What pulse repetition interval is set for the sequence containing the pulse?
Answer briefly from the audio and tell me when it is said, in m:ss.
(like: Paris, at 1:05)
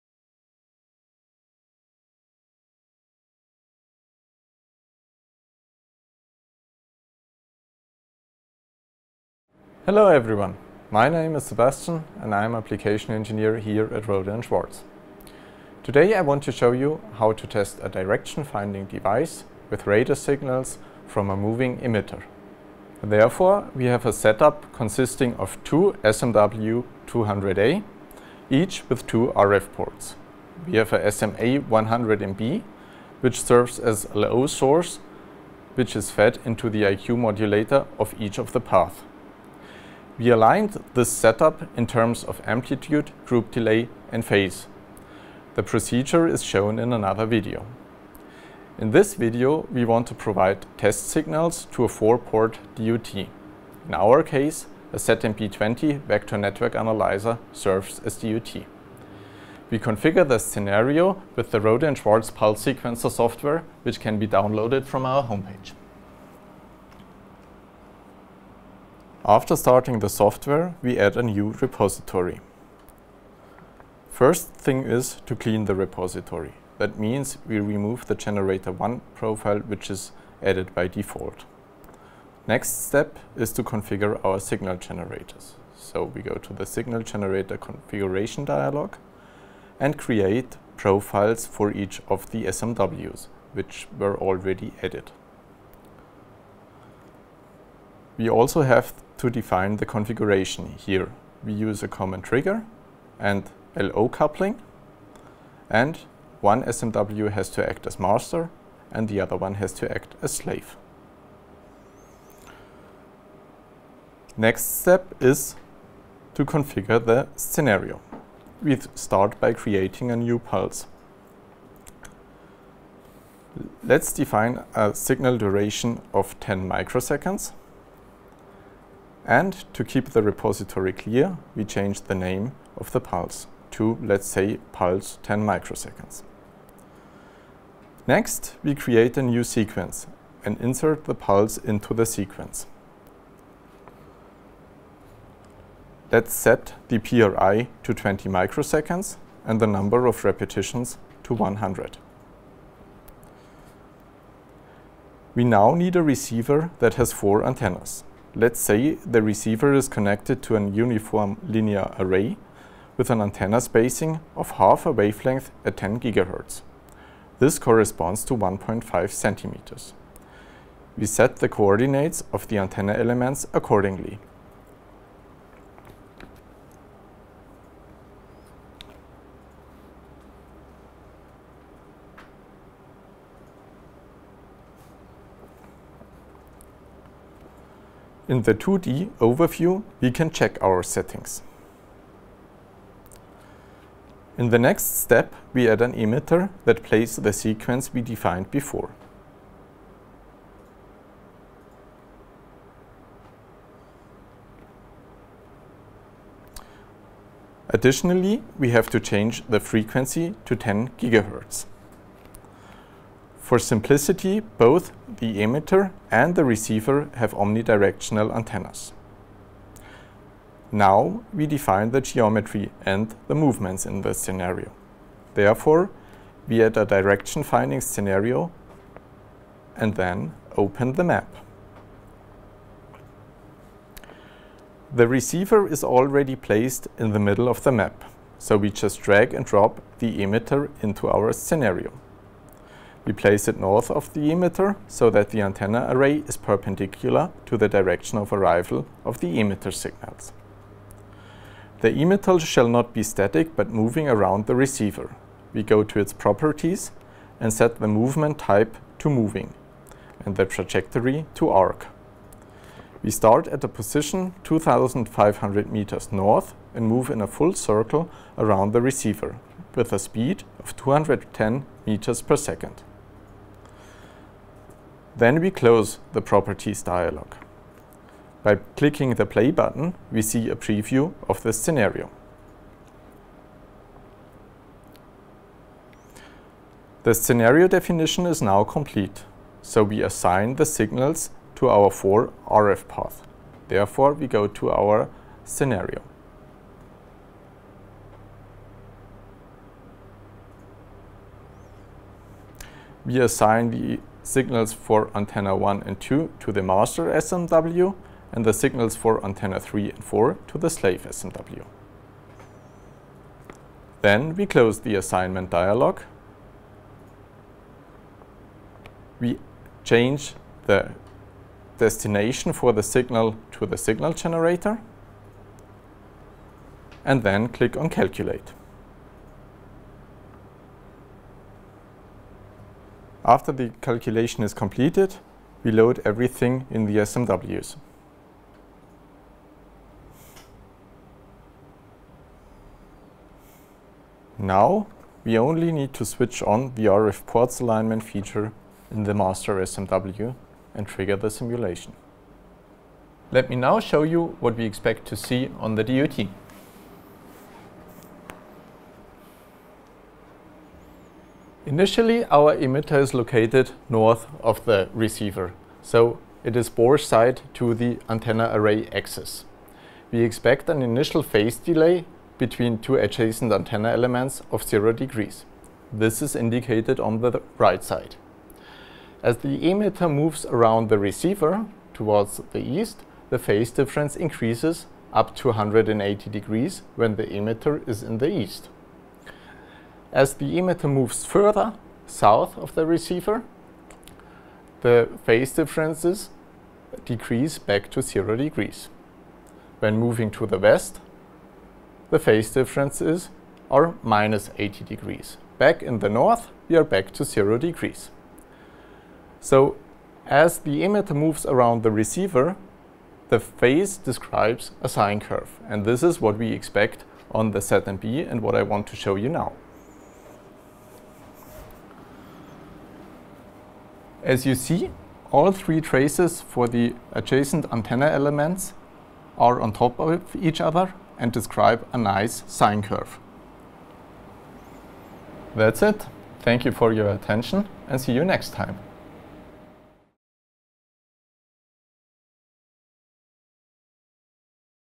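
20 microseconds, at 2:27.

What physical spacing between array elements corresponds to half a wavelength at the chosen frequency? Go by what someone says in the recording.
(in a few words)
1.5 centimeters.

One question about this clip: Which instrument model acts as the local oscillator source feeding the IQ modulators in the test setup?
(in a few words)
SMA100MB.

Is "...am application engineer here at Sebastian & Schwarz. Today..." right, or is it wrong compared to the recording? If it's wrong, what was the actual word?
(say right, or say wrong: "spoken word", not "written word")
wrong: "Rohde", not "Sebastian".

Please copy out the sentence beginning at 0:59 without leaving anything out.
We configure the scenario with the Rohde and Schwarz pulse sequencer software, which can be downloaded from our homepage.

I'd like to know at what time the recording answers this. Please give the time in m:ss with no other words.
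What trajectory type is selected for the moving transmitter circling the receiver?
4:21.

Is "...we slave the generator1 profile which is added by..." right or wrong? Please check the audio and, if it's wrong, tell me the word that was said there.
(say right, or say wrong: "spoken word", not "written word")
wrong: "remove", not "slave".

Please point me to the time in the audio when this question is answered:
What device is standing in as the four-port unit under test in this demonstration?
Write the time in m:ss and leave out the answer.
0:54.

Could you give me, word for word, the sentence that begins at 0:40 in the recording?
We aligned this setup in terms of amplitude, group delay and phase.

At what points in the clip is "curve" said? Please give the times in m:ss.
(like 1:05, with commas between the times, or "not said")
6:55, 7:12.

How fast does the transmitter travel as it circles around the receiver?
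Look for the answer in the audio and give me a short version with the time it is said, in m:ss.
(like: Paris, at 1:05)
210 meters per second, at 4:30.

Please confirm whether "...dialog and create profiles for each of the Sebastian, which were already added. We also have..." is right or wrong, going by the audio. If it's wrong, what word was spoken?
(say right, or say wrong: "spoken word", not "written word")
wrong: "SMWs", not "Sebastian".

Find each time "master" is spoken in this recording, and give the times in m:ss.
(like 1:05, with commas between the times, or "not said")
1:47, 5:06, 5:49.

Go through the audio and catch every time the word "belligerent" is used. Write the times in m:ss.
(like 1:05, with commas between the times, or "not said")
not said.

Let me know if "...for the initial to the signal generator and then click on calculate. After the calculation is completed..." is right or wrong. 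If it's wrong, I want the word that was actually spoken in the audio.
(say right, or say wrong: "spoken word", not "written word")
wrong: "signal", not "initial".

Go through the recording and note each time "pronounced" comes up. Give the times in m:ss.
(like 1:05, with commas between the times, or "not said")
not said.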